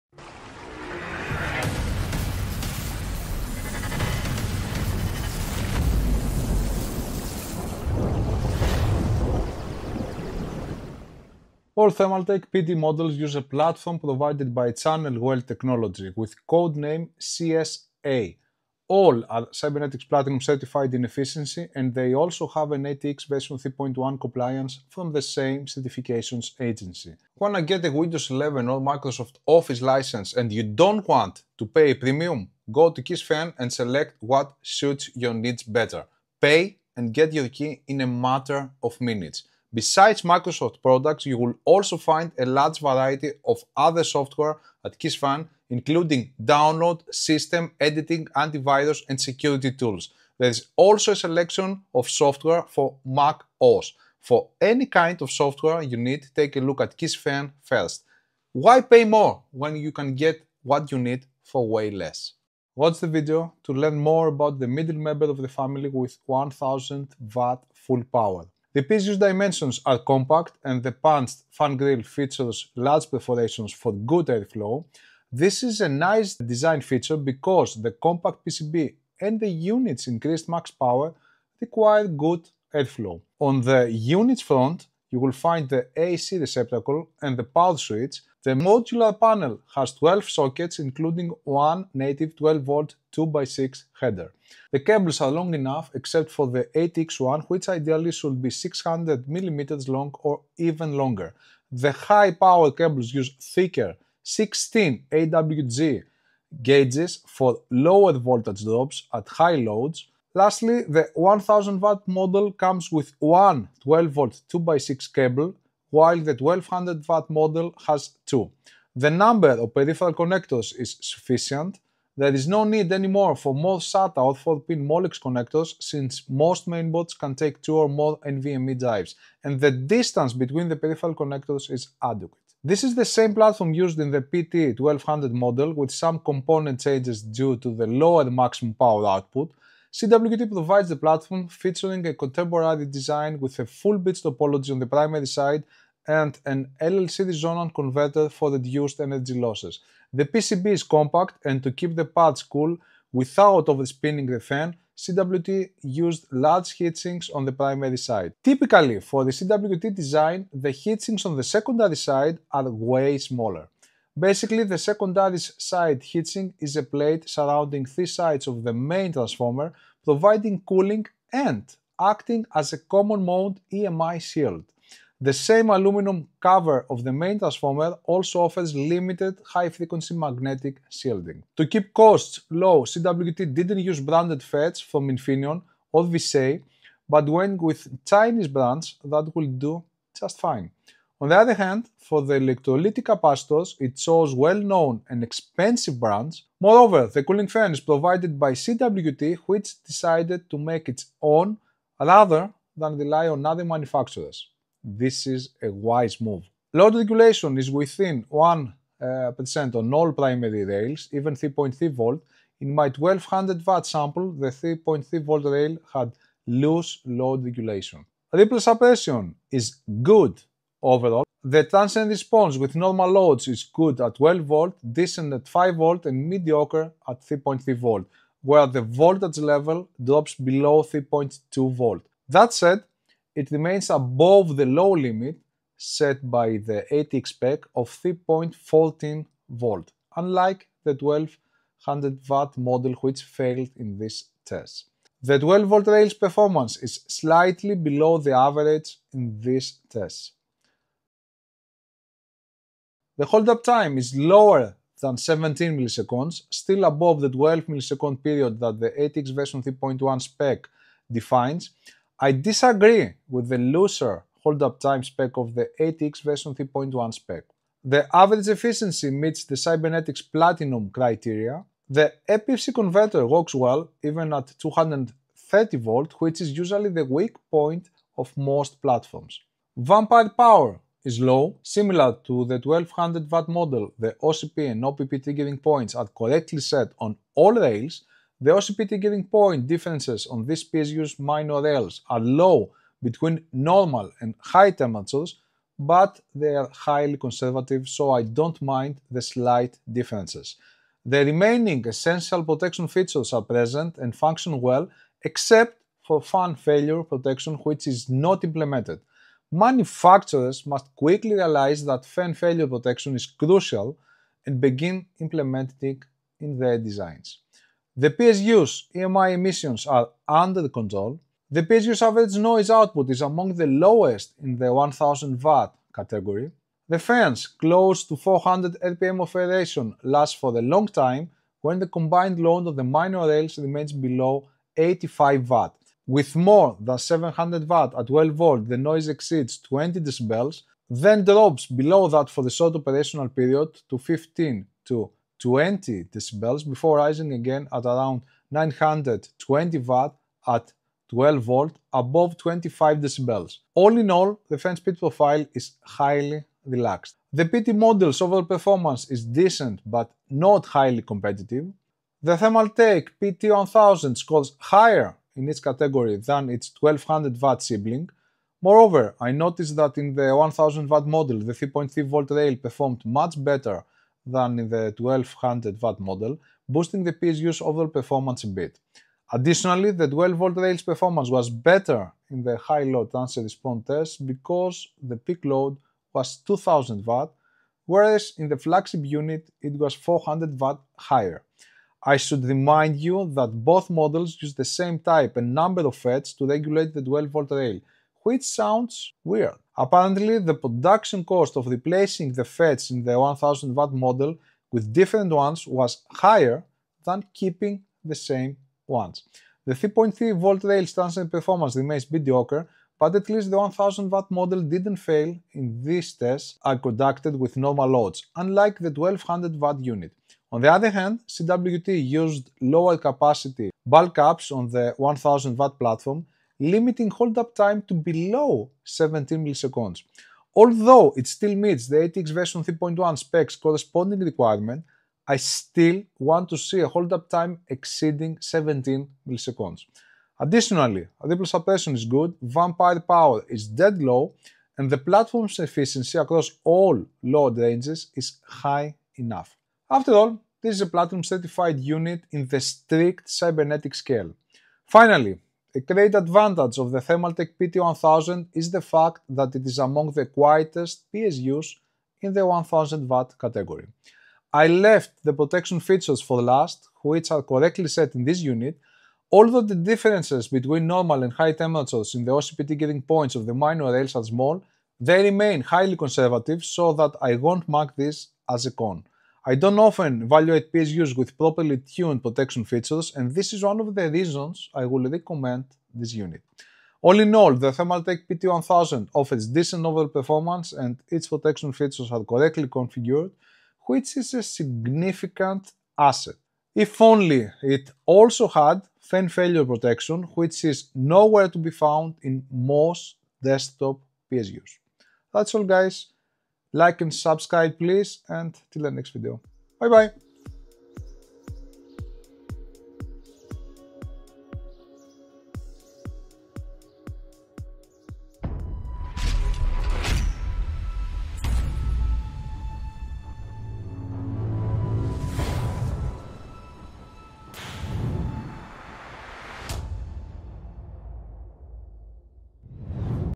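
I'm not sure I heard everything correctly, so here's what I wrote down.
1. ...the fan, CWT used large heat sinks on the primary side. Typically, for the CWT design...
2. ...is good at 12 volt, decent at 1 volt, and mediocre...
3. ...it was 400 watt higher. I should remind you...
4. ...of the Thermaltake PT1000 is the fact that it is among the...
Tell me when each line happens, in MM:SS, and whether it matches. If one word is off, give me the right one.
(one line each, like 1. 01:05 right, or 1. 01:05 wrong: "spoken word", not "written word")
1. 02:34 right
2. 03:43 wrong: "5", not "1"
3. 06:29 right
4. 07:36 right.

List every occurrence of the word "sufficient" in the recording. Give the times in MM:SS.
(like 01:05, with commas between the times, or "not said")
02:01.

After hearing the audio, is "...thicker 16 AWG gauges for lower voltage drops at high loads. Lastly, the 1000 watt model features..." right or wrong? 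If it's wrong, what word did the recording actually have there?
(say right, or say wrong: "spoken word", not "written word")
wrong: "comes", not "features".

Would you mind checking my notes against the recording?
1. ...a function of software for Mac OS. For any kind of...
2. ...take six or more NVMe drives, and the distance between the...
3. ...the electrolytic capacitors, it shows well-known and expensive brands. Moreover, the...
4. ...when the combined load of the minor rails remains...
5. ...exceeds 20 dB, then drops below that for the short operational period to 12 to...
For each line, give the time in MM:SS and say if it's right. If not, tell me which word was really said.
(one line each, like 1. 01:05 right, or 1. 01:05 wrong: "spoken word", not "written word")
1. 00:51 wrong: "selection", not "function"
2. 02:07 wrong: "two", not "six"
3. 03:12 right
4. 05:31 right
5. 05:39 wrong: "15", not "12".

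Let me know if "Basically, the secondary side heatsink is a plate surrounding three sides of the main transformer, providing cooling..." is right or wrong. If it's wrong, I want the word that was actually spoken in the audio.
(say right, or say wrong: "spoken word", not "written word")
right.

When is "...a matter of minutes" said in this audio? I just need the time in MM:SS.
00:38.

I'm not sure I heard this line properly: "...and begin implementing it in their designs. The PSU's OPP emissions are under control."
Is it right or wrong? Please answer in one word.
wrong.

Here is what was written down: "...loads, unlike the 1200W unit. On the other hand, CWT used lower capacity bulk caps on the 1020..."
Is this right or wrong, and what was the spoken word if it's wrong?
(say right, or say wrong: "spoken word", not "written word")
wrong: "1000", not "1020".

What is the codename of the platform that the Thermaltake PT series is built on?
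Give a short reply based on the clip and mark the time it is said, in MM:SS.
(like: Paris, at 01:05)
CSA, at 00:17.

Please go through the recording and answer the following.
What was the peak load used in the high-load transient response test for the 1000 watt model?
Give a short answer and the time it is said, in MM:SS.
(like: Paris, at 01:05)
2000 watt, at 06:26.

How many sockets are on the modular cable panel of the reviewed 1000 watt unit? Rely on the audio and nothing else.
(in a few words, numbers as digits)
12.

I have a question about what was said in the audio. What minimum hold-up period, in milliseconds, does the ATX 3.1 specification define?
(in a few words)
12 milliseconds.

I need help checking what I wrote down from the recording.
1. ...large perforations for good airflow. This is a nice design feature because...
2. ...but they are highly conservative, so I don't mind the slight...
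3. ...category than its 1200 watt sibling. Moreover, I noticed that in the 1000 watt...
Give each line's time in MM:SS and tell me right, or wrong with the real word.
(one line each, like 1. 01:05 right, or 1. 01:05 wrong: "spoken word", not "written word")
1. 01:12 right
2. 04:55 right
3. 06:05 right.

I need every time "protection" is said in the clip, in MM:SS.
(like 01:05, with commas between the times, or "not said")
05:02, 05:07, 05:12, 07:45, 08:02, 08:11, 08:19.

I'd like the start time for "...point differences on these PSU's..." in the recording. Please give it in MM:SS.
04:49.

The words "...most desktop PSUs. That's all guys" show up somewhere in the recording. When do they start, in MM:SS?
08:22.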